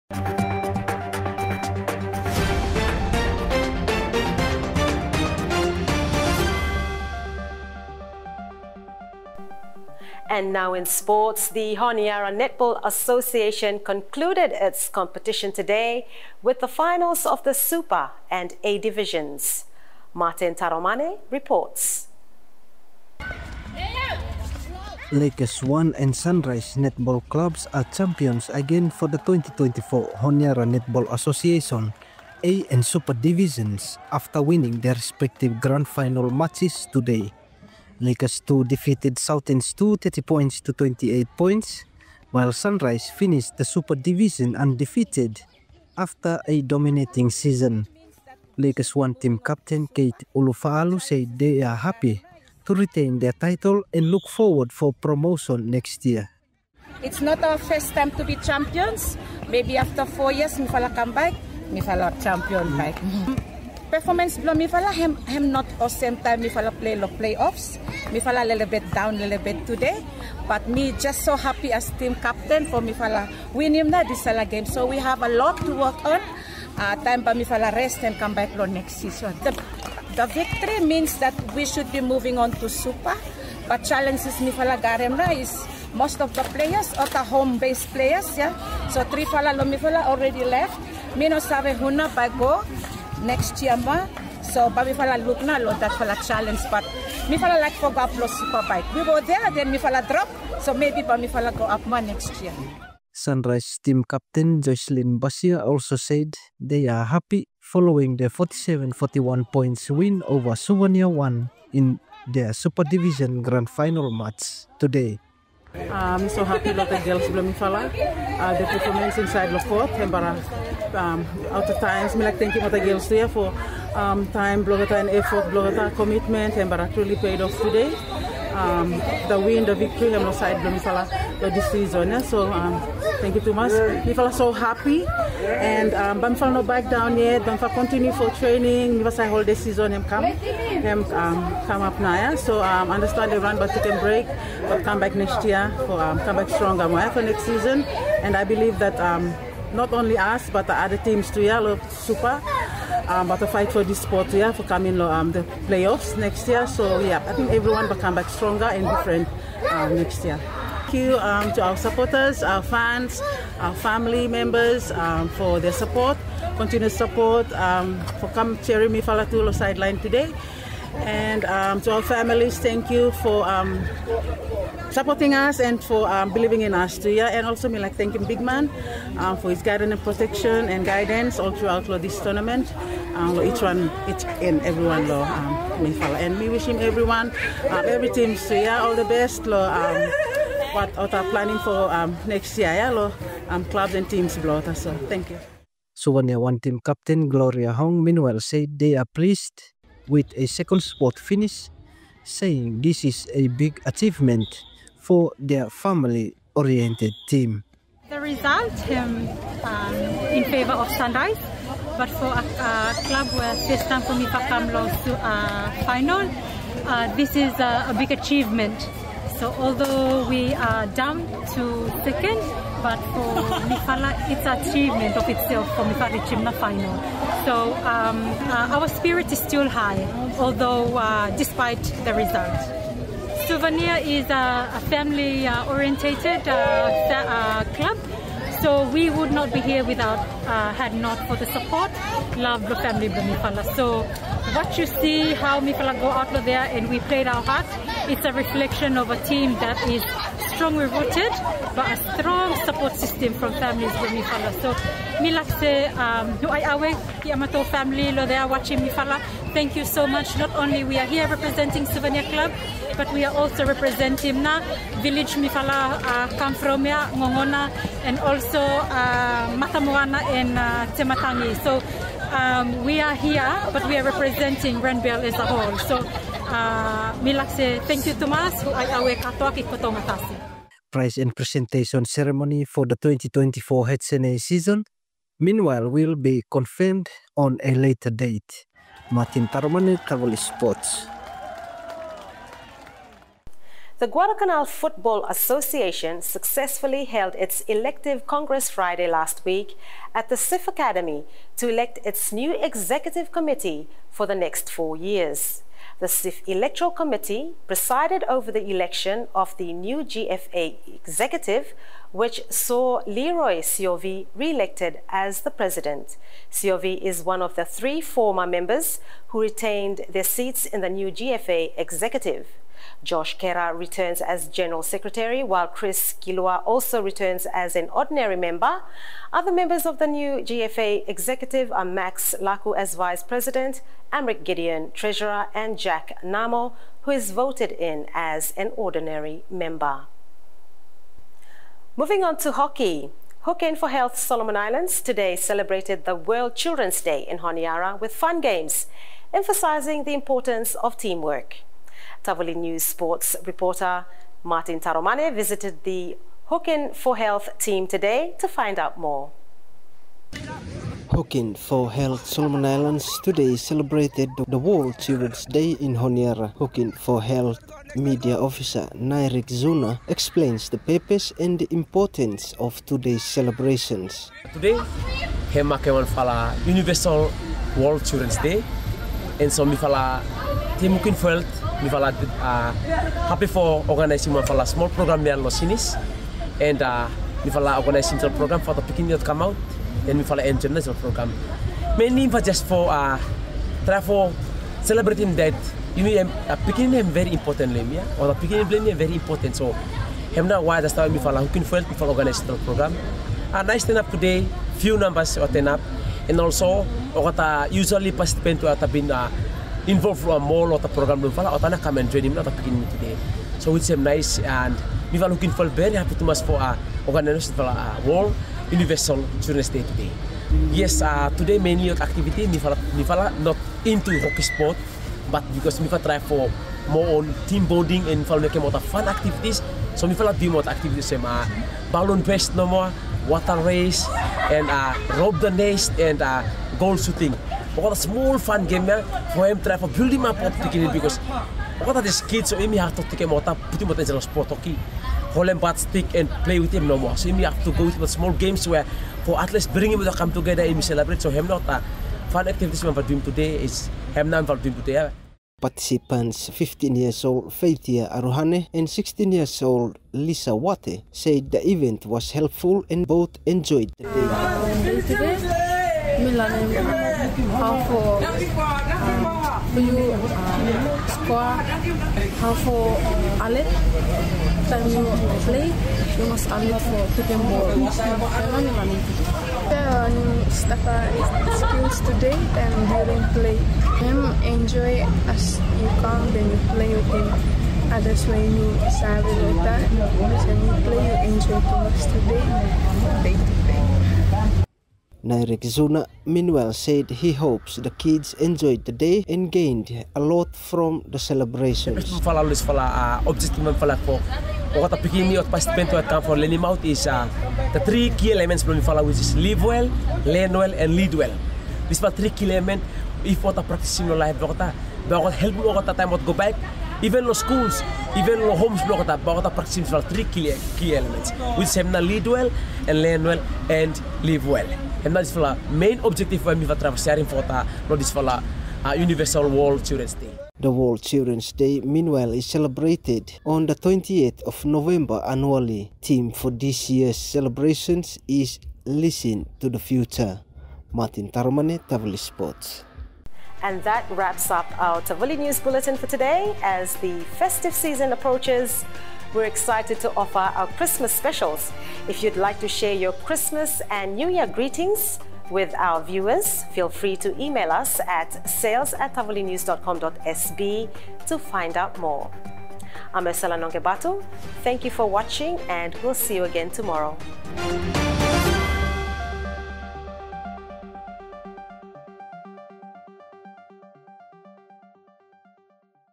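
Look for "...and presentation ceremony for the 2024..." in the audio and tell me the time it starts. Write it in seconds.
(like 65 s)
281 s.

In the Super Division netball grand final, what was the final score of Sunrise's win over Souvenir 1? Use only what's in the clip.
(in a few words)
47-41.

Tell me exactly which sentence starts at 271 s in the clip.
So um, we are here, but we are representing Renbel as a whole.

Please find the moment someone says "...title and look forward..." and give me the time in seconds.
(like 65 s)
53 s.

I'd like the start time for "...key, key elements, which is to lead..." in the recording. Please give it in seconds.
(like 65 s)
520 s.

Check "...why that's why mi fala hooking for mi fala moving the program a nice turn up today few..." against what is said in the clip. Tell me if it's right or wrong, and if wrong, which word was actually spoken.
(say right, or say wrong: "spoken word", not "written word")
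wrong: "organizing", not "moving".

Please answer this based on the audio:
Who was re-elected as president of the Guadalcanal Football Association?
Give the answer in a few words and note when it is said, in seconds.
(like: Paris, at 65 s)
Leroy Siovi, at 313 s.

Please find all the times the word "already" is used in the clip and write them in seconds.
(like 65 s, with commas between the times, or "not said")
90 s.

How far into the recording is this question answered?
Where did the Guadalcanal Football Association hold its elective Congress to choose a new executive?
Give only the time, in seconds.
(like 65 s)
300 s.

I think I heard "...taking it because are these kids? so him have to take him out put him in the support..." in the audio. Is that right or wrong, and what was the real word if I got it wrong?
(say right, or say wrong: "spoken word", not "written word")
wrong: "sport", not "support".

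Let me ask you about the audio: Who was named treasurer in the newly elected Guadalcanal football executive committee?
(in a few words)
Amric Gideon.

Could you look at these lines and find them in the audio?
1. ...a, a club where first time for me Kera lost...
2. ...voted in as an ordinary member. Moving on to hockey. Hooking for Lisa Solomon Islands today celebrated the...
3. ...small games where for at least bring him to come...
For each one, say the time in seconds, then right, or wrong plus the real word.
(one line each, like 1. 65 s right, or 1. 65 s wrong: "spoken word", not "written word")
1. 212 s wrong: "Mifakam", not "Kera"
2. 337 s wrong: "Health", not "Lisa"
3. 448 s right.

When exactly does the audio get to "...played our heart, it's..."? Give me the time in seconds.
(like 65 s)
246 s.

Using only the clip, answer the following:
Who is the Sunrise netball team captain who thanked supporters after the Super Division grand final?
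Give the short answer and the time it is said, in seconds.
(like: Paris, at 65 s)
Jocelyn Basia, at 104 s.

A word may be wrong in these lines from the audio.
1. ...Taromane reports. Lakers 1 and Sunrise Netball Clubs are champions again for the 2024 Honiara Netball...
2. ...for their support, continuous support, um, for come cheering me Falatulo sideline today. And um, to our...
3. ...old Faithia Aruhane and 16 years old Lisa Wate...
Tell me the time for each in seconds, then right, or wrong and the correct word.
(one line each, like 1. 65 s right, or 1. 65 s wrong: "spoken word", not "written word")
1. 20 s right
2. 165 s right
3. 457 s right.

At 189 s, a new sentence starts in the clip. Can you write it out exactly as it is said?
Um what, what are planning for um, next year.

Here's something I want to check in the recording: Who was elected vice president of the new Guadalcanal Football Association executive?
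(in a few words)
Max Laku.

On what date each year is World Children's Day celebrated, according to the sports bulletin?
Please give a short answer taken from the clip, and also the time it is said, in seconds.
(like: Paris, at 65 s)
28th of November, at 533 s.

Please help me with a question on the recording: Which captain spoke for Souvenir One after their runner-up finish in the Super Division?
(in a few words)
Gloria Hong.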